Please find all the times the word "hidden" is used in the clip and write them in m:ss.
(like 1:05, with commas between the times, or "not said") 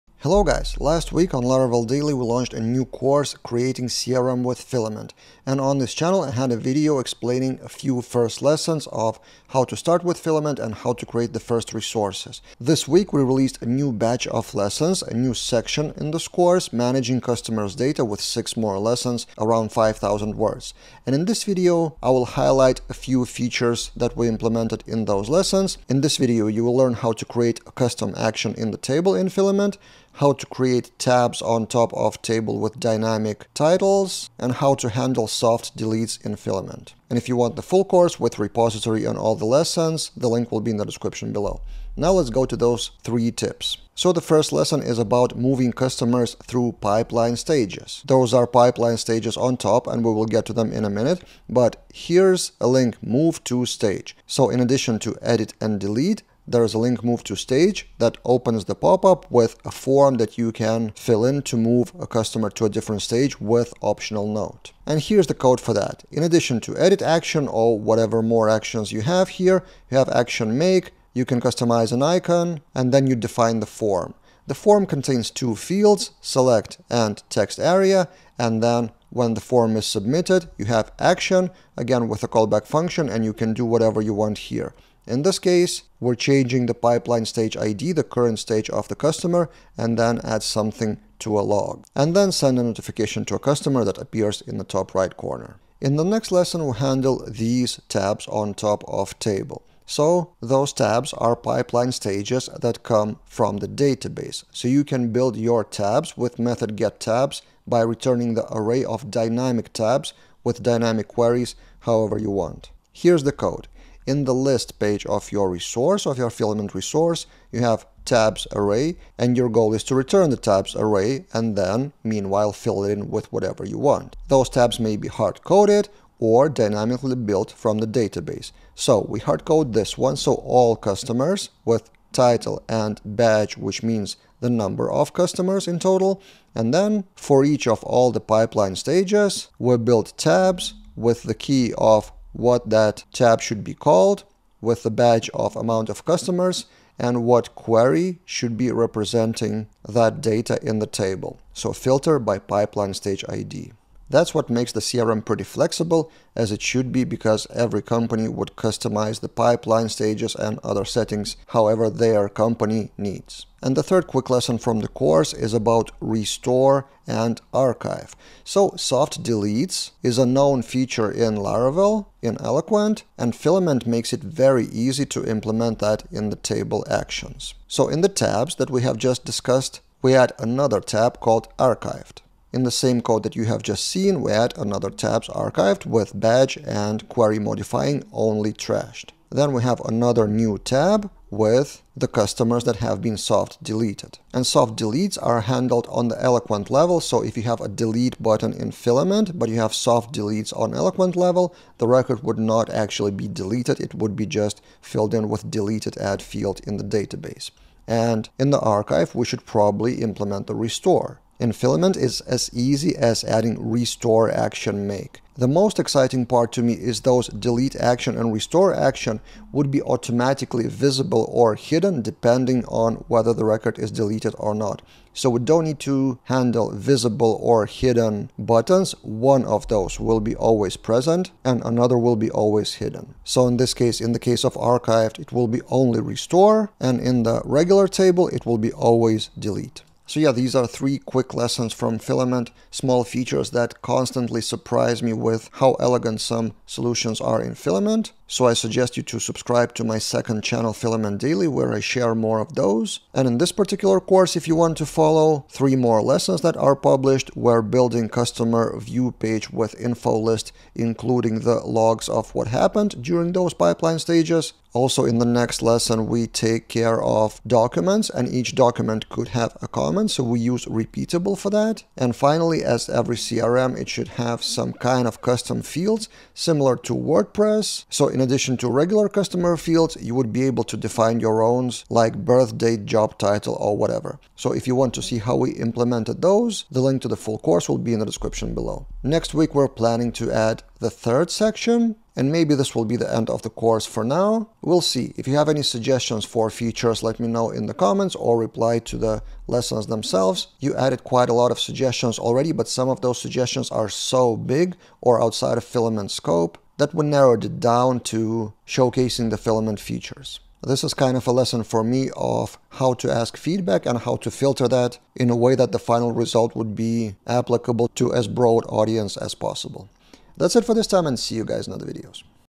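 3:41, 3:47, 3:52.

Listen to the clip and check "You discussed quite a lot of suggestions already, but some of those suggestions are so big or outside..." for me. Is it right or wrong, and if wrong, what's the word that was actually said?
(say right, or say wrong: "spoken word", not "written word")
wrong: "added", not "discussed".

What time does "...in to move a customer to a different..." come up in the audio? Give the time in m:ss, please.
1:01.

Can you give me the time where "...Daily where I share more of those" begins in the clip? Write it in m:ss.
4:11.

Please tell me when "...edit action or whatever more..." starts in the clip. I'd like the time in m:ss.
1:06.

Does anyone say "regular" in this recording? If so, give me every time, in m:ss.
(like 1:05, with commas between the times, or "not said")
3:57, 4:38.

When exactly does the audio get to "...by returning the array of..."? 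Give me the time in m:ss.
1:47.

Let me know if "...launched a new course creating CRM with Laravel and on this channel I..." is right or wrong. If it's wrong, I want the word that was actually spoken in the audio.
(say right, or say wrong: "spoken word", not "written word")
wrong: "Filament", not "Laravel".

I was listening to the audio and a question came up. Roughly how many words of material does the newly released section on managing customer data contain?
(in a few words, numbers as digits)
5000.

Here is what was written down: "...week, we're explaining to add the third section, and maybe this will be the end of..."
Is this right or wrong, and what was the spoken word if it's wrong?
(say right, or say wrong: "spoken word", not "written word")
wrong: "planning", not "explaining".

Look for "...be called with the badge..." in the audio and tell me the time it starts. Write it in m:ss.
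2:23.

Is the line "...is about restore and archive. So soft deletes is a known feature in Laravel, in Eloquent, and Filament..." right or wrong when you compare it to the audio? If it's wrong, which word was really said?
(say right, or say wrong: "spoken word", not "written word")
right.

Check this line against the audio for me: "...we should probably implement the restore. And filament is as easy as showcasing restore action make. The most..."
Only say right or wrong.
wrong.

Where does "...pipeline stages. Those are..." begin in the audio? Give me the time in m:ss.
0:46.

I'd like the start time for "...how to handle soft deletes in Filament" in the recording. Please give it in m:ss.
0:34.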